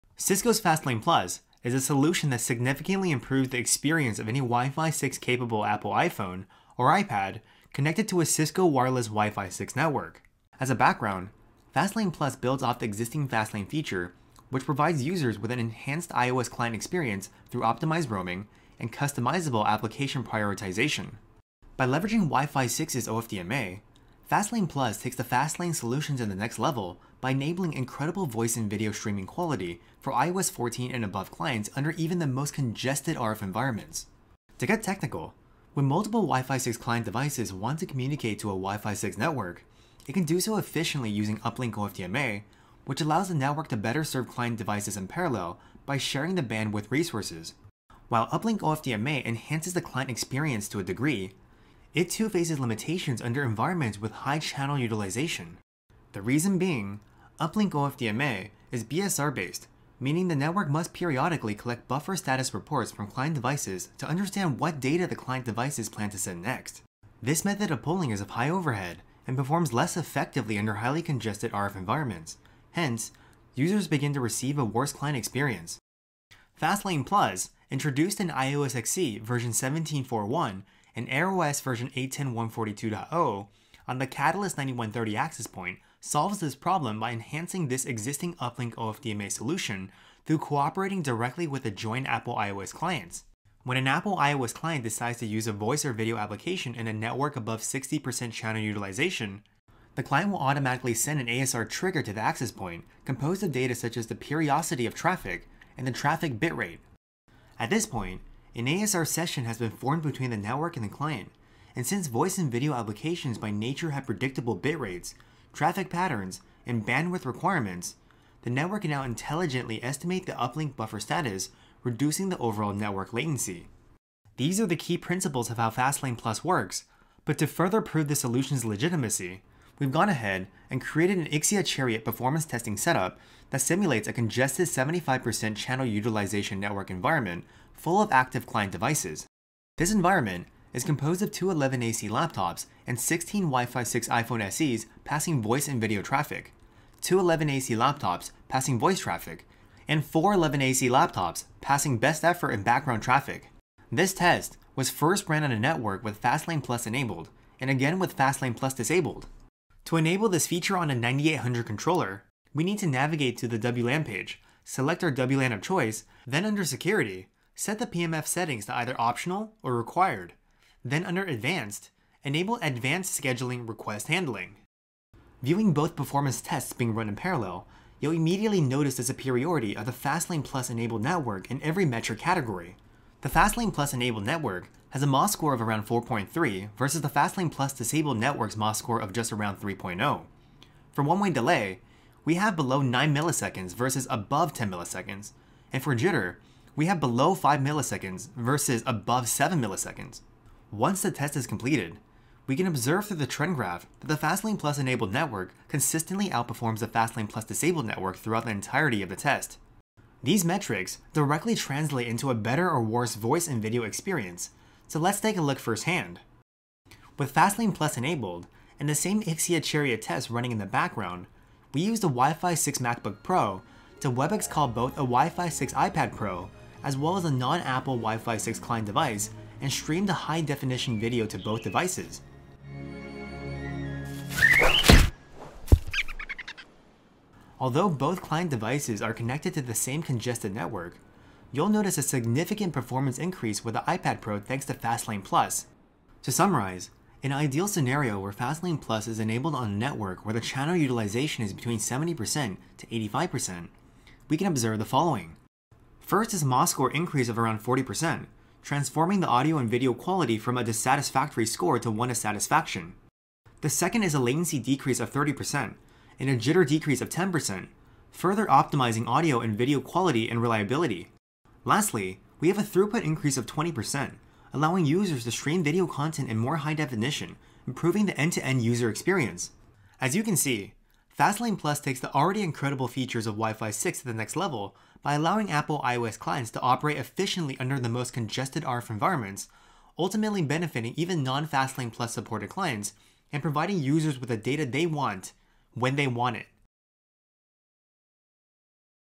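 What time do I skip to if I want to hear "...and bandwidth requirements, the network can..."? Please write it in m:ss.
1:56.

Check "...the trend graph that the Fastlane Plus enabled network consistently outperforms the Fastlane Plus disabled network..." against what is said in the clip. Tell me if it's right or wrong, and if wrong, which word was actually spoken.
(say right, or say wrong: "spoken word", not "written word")
right.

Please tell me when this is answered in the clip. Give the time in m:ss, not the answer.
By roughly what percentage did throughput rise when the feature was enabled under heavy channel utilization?
4:33.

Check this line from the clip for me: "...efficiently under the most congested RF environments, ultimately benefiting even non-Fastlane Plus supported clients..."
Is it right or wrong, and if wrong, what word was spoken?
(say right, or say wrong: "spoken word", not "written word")
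right.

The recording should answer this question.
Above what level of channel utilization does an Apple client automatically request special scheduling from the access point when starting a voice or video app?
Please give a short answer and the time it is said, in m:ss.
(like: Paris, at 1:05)
60%, at 1:37.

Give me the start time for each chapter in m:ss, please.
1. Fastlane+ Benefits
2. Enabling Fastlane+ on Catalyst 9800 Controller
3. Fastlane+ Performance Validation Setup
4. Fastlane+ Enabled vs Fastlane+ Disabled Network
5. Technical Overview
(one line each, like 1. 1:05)
1. 4:05
2. 2:40
3. 2:04
4. 2:55
5. 0:34.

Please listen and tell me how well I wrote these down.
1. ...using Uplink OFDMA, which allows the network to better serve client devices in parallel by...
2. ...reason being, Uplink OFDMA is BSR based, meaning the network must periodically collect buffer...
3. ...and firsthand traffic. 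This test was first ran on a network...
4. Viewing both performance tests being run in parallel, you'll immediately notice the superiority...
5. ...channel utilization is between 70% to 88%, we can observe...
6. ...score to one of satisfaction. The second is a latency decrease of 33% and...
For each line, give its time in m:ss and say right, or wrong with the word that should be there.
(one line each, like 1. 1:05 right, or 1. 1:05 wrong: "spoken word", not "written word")
1. 0:41 right
2. 0:56 right
3. 2:32 wrong: "background", not "firsthand"
4. 2:55 right
5. 4:10 wrong: "85", not "88"
6. 4:21 wrong: "30", not "33".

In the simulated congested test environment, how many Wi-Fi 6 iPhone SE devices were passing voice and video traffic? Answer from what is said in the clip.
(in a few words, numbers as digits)
16.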